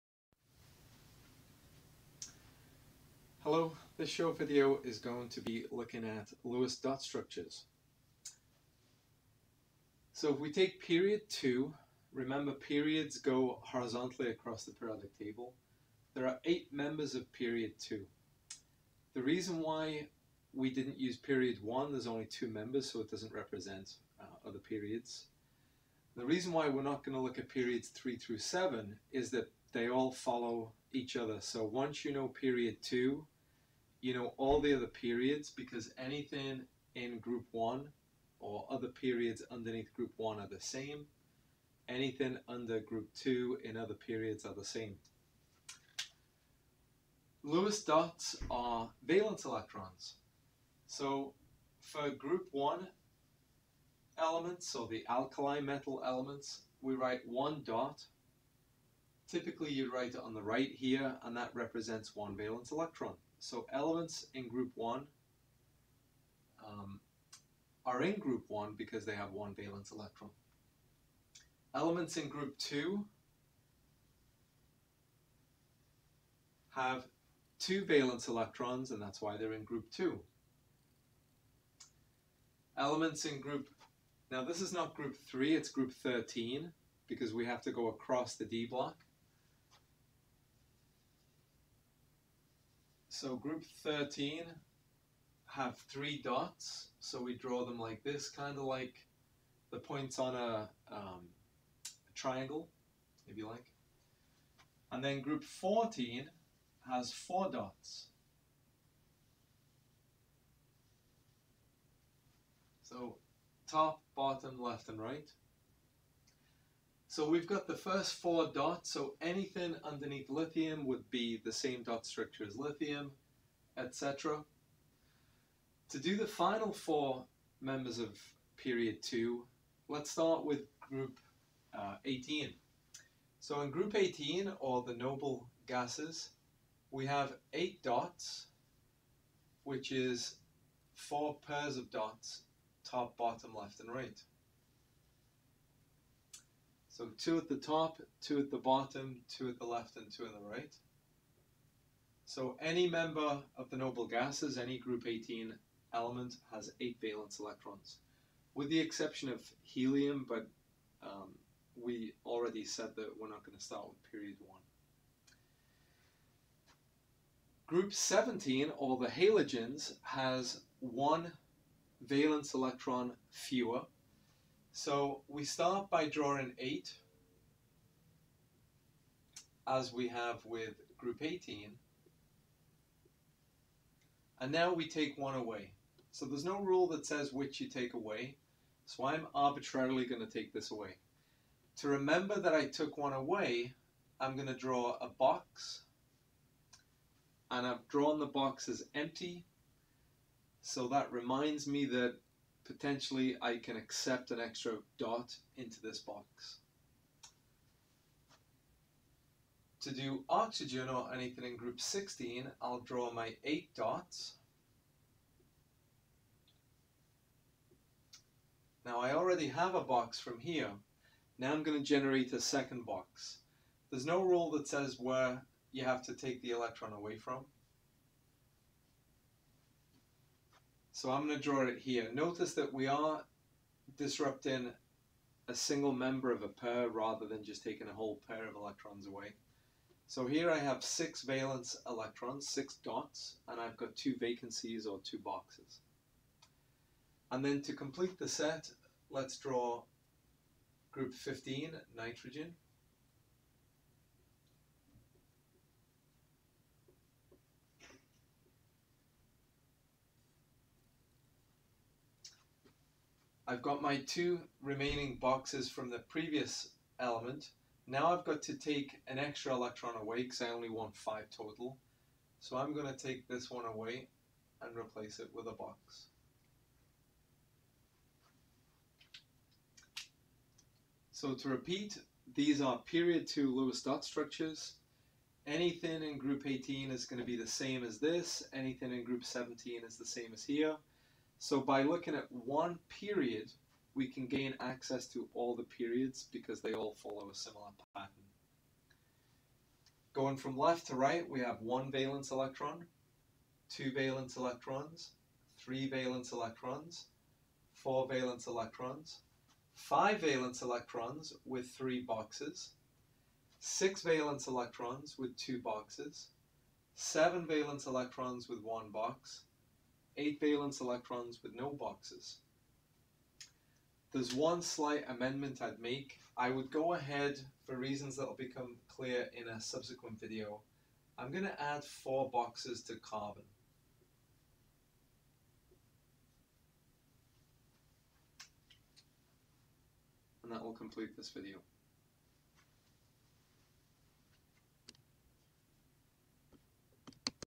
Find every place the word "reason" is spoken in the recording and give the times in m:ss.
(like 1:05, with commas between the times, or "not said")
0:19, 0:26, 5:27.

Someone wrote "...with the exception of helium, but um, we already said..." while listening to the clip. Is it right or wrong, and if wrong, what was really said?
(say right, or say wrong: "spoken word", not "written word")
right.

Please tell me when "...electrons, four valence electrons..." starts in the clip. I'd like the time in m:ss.
5:06.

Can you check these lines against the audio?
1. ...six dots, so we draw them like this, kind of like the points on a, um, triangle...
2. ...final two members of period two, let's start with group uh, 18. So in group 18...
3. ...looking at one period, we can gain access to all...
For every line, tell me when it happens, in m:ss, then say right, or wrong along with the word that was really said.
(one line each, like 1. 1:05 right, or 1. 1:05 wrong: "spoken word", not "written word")
1. 1:35 wrong: "three", not "six"
2. 2:06 wrong: "four", not "two"
3. 4:51 right.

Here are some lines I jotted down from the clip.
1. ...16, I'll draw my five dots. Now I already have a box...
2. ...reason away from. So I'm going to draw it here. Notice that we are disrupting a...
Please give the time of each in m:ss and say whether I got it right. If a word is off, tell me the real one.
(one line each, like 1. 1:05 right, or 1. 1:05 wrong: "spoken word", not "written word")
1. 3:31 wrong: "eight", not "five"
2. 3:46 wrong: "electron", not "reason".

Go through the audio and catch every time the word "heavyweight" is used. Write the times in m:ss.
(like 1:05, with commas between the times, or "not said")
not said.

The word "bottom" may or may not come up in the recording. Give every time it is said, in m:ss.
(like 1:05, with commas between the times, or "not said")
1:54, 2:23, 2:28.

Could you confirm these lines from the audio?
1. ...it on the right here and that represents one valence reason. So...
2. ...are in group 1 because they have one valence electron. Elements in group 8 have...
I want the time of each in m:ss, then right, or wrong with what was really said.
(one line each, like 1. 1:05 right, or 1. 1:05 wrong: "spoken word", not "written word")
1. 1:00 wrong: "electron", not "reason"
2. 1:07 wrong: "2", not "8".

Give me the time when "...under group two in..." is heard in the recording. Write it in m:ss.
0:42.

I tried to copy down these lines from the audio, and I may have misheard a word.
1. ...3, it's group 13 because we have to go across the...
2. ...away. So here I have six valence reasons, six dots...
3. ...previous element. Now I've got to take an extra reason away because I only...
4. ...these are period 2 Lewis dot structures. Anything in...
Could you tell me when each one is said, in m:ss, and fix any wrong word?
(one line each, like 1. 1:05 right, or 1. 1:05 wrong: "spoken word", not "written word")
1. 1:25 right
2. 3:59 wrong: "electrons", not "reasons"
3. 4:25 wrong: "electron", not "reason"
4. 4:42 right.